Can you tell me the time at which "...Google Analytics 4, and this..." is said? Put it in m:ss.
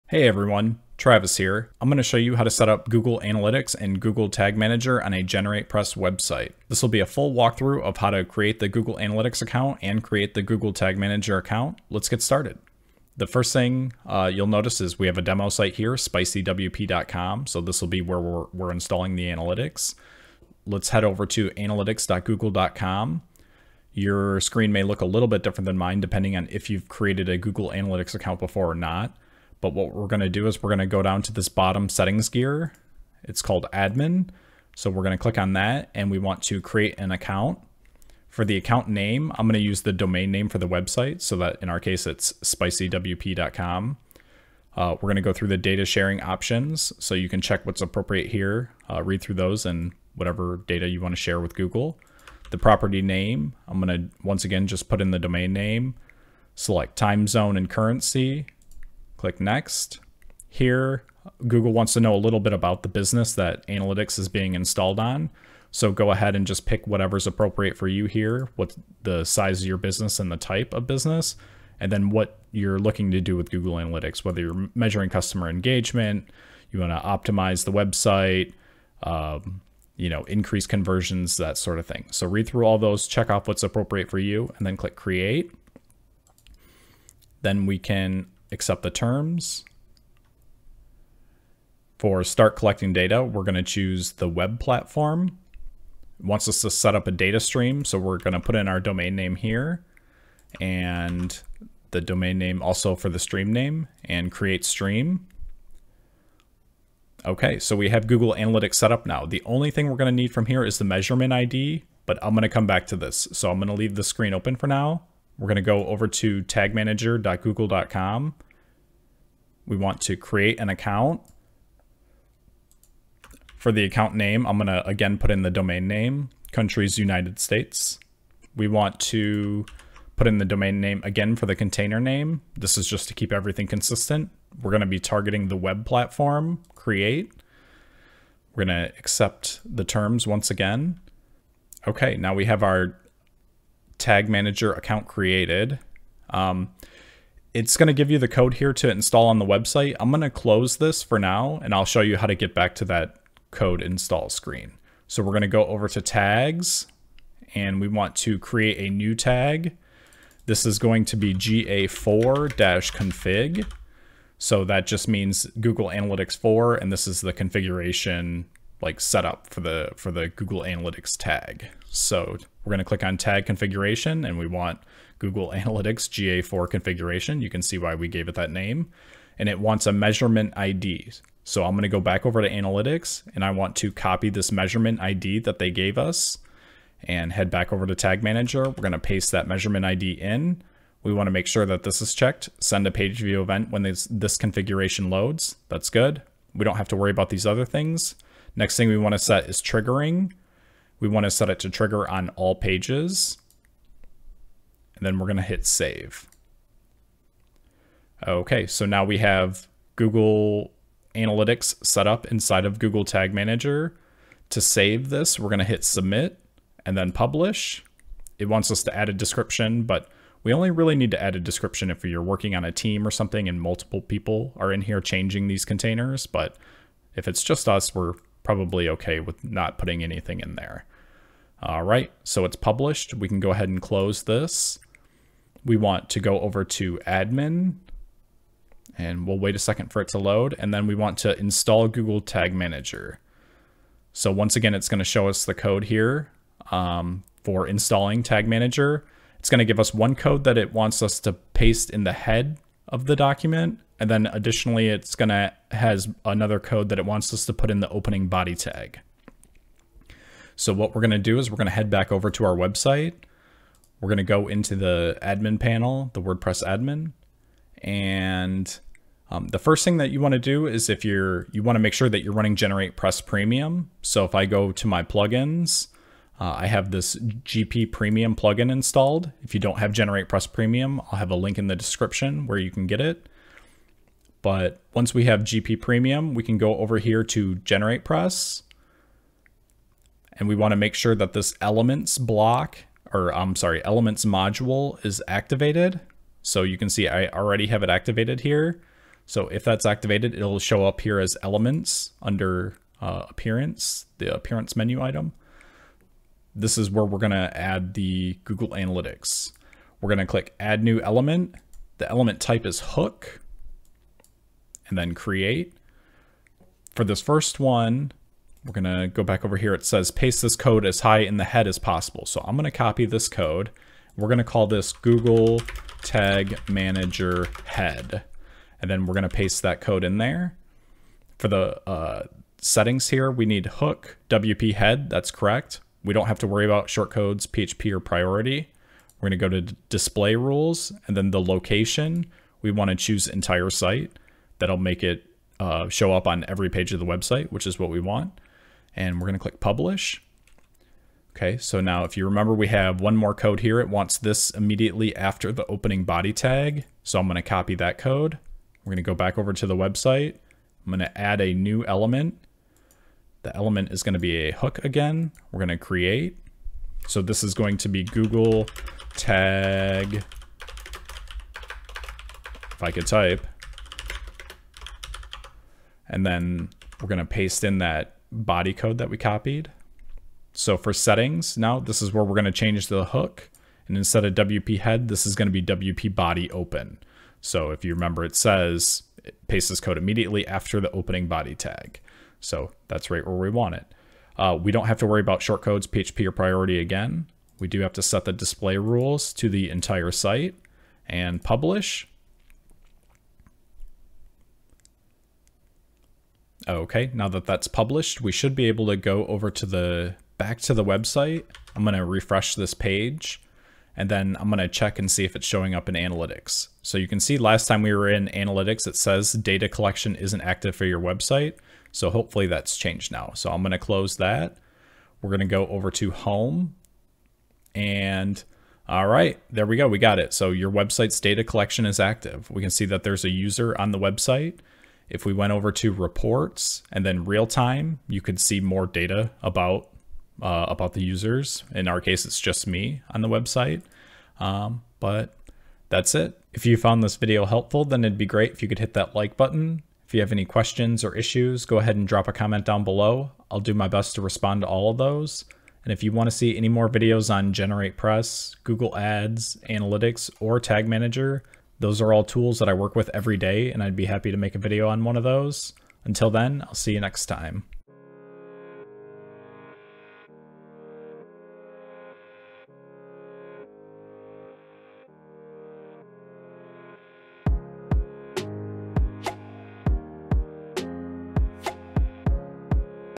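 2:45.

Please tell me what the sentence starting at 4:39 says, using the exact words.
If you don't have GeneratePress Premium, I'll have a link in the description where you can get it.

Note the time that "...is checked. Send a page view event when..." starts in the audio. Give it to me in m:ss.
3:12.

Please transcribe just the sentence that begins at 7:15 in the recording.
If we went over to reports and then real time, you could see more data about uh, about the users.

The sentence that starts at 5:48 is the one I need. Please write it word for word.
And we're going to click publish.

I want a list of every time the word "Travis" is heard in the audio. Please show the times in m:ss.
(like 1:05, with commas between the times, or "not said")
0:00.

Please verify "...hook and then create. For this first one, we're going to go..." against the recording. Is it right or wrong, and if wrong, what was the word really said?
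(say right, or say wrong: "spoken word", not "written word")
right.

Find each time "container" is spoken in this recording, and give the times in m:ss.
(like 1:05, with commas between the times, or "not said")
2:11, 3:45.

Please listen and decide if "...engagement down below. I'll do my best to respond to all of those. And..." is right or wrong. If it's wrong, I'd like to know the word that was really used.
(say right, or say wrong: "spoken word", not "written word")
wrong: "comment", not "engagement".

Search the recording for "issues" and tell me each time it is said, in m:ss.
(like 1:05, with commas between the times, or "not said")
7:31.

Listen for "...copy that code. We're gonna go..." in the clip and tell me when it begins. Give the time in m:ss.
5:57.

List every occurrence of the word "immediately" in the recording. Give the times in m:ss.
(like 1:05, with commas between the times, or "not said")
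5:54, 6:29.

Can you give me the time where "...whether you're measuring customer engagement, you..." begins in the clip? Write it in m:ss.
1:14.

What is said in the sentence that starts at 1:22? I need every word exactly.
So read through all those, check off what's appropriate for you, and then click create.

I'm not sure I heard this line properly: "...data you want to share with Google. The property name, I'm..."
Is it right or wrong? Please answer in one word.
right.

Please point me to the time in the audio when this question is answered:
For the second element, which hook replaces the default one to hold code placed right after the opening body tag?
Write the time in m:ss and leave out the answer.
6:25.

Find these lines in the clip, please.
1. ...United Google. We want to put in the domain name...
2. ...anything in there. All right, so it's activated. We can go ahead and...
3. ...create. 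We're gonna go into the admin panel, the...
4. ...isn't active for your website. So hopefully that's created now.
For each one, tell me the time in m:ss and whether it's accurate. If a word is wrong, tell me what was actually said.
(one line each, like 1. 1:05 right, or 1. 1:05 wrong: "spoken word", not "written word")
1. 2:06 wrong: "States", not "Google"
2. 3:50 wrong: "published", not "activated"
3. 4:22 wrong: "website", not "create"
4. 7:00 wrong: "changed", not "created".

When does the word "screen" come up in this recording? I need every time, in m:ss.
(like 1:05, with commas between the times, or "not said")
0:24, 1:54, 2:34.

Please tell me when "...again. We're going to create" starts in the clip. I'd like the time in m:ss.
6:04.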